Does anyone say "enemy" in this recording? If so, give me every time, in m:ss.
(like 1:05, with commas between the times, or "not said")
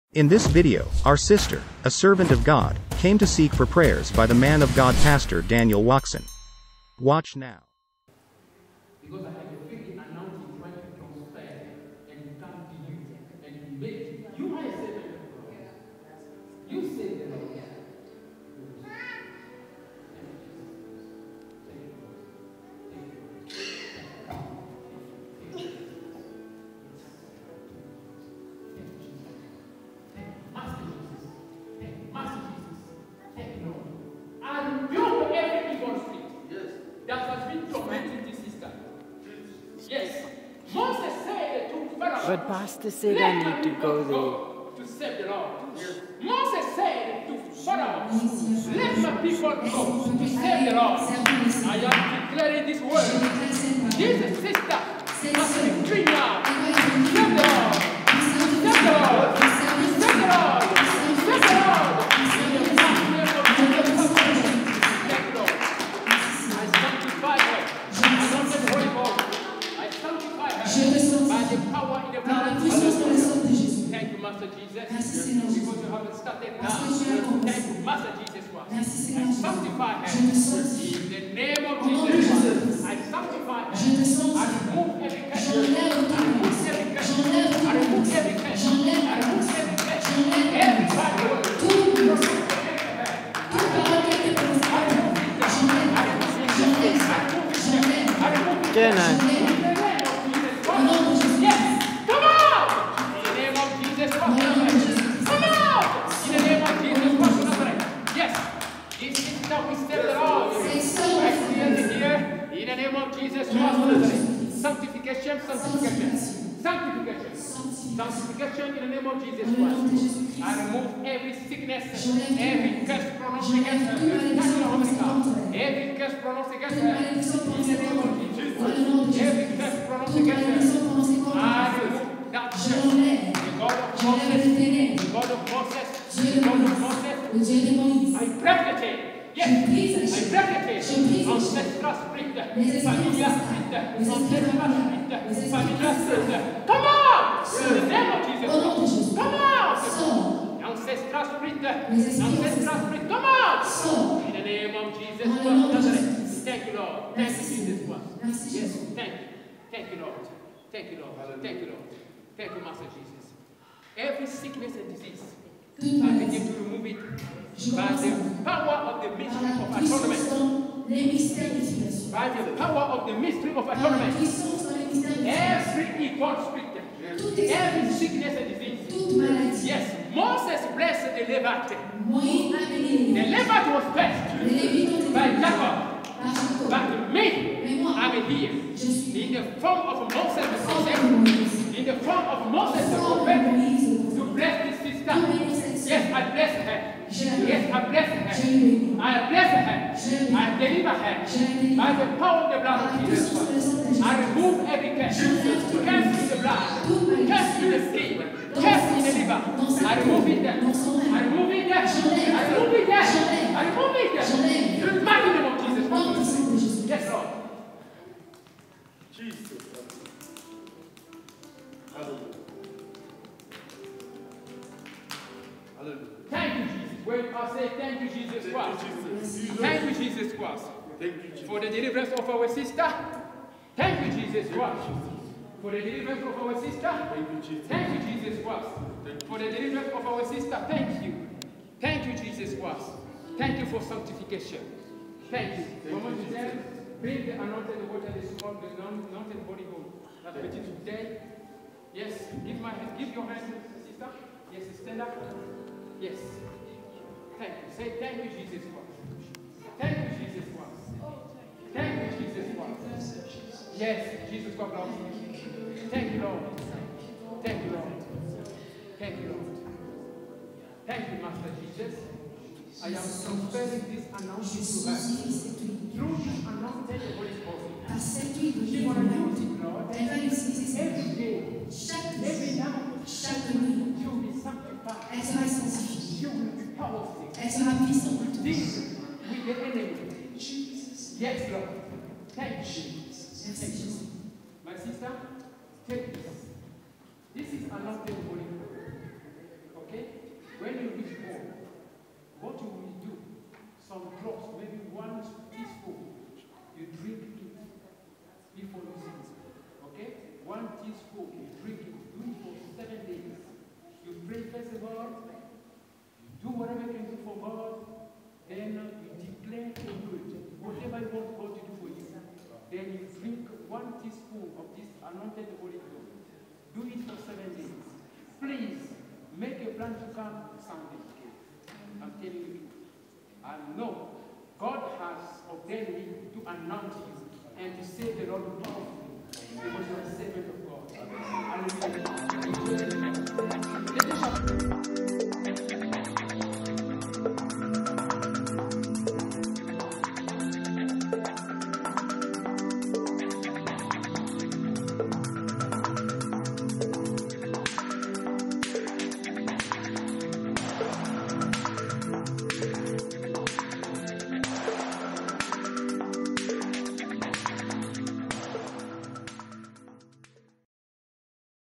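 4:49.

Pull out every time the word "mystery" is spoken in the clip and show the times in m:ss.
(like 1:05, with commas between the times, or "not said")
2:49, 2:53.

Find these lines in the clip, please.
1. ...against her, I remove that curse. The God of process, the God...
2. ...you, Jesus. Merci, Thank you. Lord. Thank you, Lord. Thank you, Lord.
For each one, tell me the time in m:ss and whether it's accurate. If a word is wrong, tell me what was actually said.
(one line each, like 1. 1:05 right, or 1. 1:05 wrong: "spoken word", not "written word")
1. 2:10 right
2. 2:37 right.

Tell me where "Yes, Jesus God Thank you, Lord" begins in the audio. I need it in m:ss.
4:23.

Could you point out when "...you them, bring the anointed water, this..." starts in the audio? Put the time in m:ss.
4:06.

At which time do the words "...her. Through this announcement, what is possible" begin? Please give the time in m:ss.
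4:34.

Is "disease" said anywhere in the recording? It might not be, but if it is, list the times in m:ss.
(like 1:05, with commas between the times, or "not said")
2:44, 2:58.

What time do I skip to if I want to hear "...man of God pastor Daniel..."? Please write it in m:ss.
0:04.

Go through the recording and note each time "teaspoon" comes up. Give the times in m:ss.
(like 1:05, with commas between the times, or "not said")
5:05, 5:10, 5:24.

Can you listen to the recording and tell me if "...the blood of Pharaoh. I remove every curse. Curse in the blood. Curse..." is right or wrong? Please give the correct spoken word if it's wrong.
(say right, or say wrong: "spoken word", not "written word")
wrong: "Jesus", not "Pharaoh".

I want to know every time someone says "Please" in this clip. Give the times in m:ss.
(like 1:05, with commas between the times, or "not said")
5:28.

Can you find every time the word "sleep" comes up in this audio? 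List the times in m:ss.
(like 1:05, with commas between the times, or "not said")
5:09.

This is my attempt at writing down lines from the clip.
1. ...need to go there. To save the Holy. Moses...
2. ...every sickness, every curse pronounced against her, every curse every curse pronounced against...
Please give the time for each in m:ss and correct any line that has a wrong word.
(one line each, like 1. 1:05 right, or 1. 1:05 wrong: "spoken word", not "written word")
1. 0:43 wrong: "Lord", not "Holy"
2. 2:01 right.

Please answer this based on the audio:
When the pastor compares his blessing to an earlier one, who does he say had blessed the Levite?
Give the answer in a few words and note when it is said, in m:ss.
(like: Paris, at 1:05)
Jacob, at 3:05.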